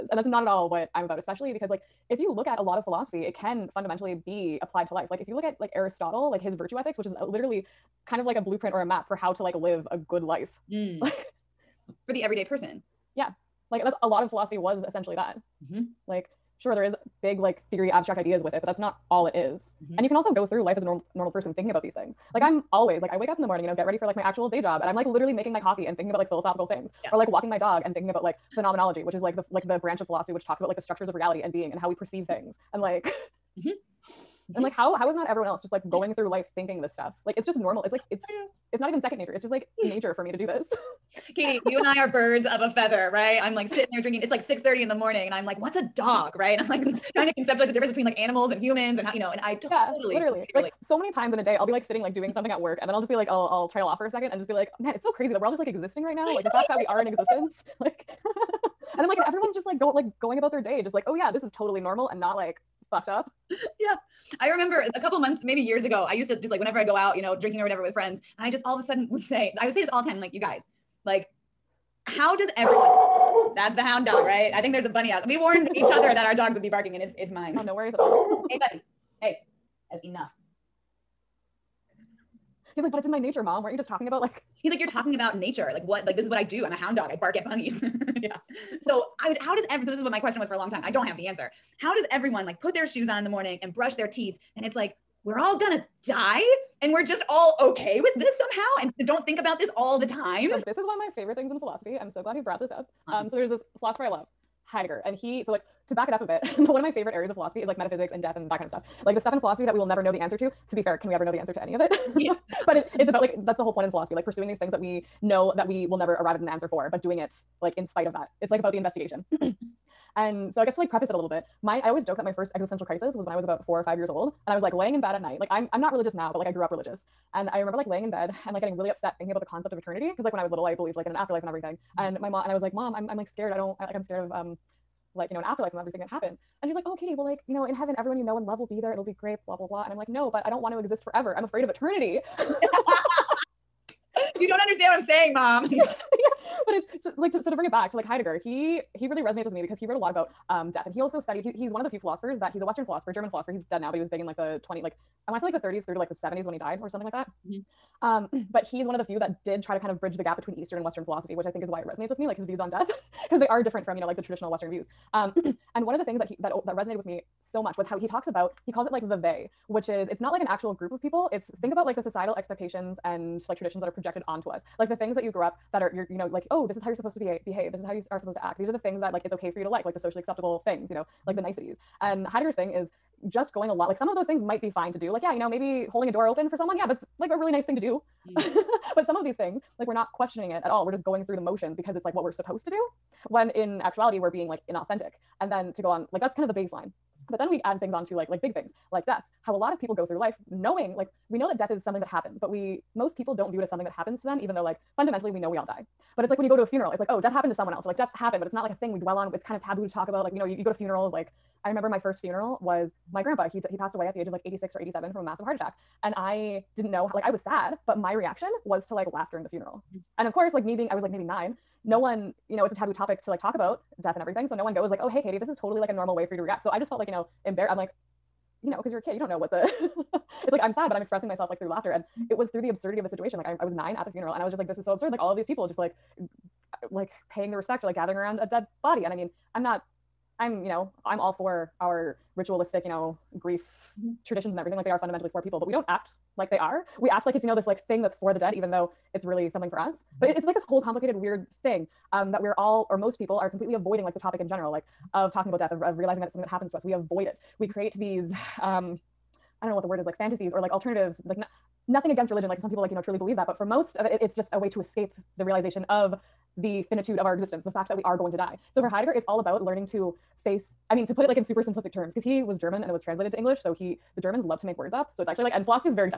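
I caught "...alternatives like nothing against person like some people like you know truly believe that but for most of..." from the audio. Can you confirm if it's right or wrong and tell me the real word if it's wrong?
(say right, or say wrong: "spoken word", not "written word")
wrong: "religion", not "person".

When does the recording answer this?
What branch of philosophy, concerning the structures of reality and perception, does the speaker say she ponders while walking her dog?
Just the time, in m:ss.
0:28.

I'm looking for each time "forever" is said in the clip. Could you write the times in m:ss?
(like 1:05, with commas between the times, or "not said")
2:21.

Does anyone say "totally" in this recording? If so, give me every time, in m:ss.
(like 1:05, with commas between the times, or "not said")
0:49, 1:01, 3:45.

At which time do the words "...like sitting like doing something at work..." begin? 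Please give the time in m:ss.
0:51.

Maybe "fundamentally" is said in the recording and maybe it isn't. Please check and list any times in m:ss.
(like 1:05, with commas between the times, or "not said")
0:03, 3:24, 4:05.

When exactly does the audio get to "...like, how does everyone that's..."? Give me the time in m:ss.
1:11.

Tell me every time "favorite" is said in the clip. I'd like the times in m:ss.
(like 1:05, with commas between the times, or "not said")
1:41, 1:46.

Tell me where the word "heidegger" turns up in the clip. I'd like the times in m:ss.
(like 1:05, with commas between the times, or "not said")
1:44, 2:28, 3:02, 4:28.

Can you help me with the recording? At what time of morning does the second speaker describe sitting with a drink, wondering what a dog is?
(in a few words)
6:30.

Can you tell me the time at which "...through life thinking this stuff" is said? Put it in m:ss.
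0:36.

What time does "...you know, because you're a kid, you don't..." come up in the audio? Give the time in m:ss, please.
3:48.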